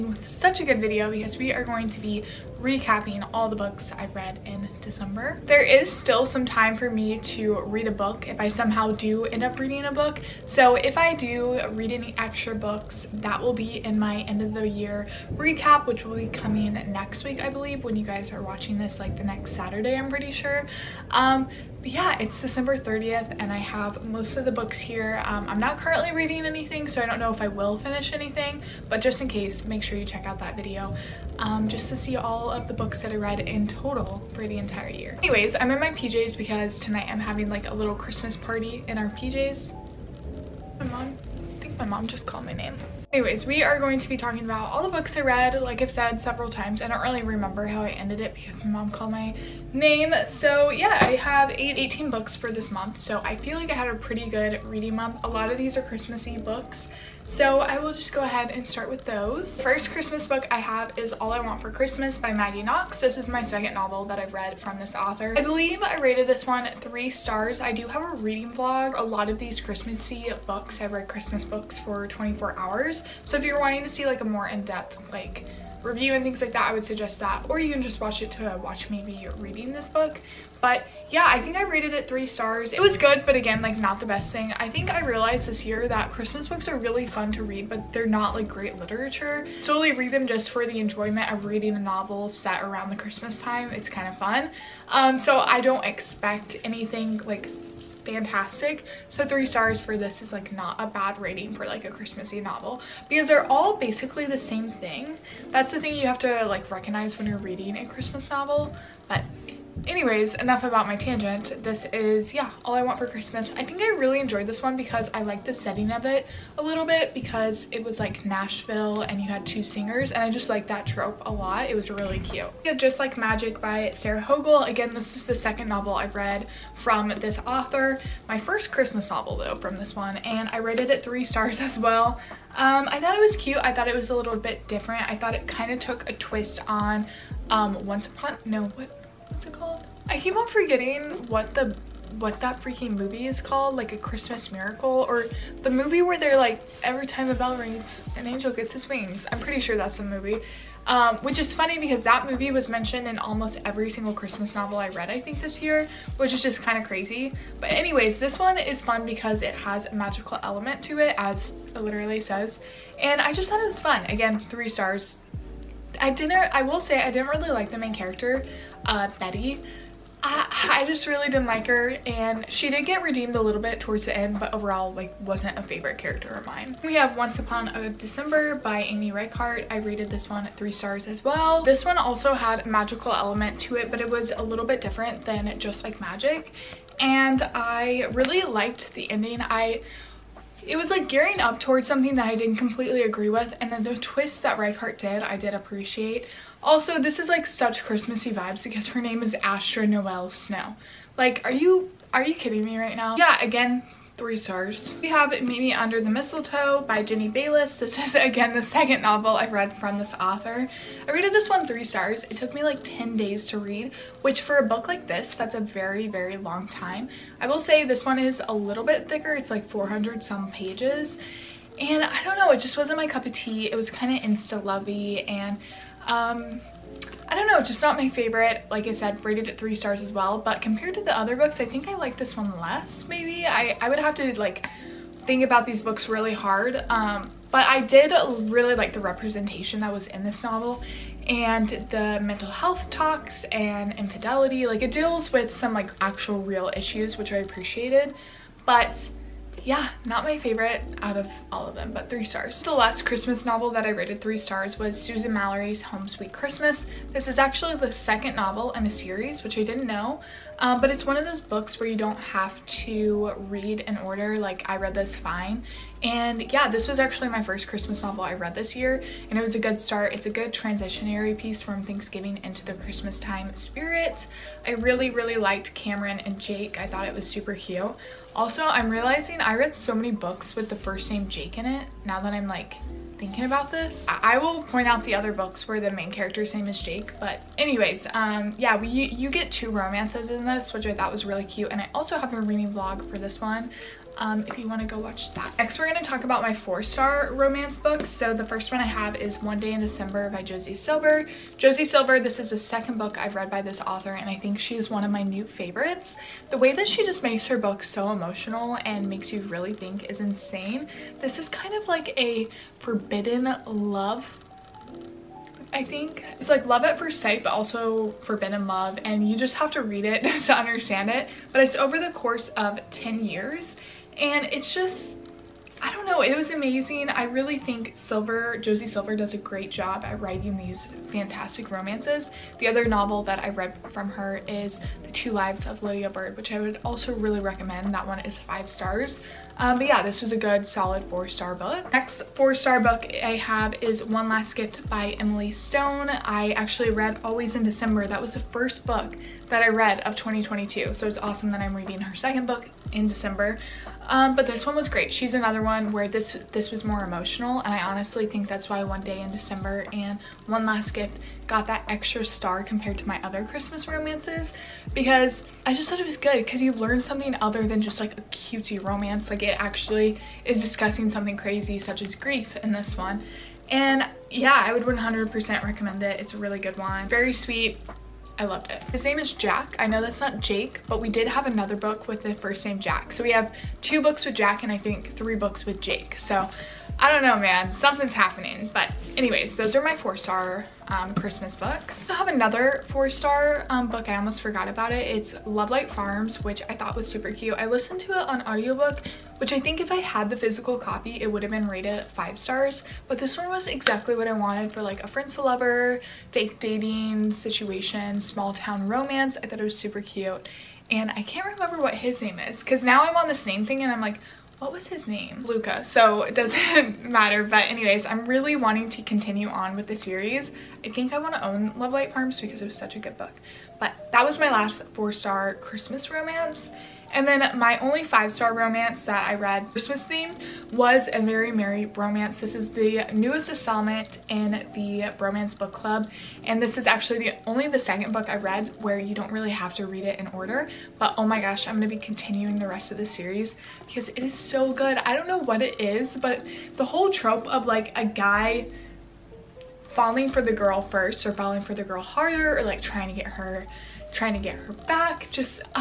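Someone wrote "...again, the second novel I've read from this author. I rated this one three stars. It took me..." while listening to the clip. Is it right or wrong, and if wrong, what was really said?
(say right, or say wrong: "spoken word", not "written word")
right.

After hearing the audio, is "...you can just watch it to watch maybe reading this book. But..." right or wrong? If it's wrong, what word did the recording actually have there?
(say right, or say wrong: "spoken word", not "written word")
right.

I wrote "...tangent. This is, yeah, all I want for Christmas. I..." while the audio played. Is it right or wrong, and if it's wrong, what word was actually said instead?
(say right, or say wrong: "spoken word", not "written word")
right.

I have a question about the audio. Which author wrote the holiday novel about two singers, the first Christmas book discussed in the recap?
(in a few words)
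Maggie Knox.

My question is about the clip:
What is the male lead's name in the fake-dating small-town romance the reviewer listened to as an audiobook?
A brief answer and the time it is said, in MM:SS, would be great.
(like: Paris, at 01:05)
Luca, at 06:55.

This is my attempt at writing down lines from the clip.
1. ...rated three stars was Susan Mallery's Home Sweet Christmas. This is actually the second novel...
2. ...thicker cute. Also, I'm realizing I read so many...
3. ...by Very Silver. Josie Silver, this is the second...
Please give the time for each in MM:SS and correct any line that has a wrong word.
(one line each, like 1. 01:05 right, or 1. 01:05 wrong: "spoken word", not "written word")
1. 04:13 right
2. 04:37 wrong: "super", not "thicker"
3. 05:00 wrong: "Josie", not "Very".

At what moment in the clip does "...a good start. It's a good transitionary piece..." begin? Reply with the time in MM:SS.
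04:29.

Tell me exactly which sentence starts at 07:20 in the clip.
But oh my gosh, I'm going to be continuing the rest of the series because it is so good.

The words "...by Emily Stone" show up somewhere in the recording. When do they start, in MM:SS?
05:44.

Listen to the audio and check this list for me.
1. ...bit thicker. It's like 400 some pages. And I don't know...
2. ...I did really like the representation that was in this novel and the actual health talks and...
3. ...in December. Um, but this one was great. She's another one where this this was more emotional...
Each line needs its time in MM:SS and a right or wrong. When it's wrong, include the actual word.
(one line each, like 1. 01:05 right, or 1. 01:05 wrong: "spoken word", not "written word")
1. 03:38 right
2. 03:57 wrong: "mental", not "actual"
3. 05:52 right.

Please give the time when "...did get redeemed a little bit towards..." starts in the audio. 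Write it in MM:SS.
02:52.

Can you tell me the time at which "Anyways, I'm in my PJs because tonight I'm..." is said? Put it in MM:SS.
00:35.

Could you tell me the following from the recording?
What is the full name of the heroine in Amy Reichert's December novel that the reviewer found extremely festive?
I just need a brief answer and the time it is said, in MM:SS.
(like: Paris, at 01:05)
Astra Noel Snow, at 03:19.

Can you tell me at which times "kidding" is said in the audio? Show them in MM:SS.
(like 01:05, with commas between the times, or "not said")
03:22.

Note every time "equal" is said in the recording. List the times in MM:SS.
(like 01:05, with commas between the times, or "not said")
not said.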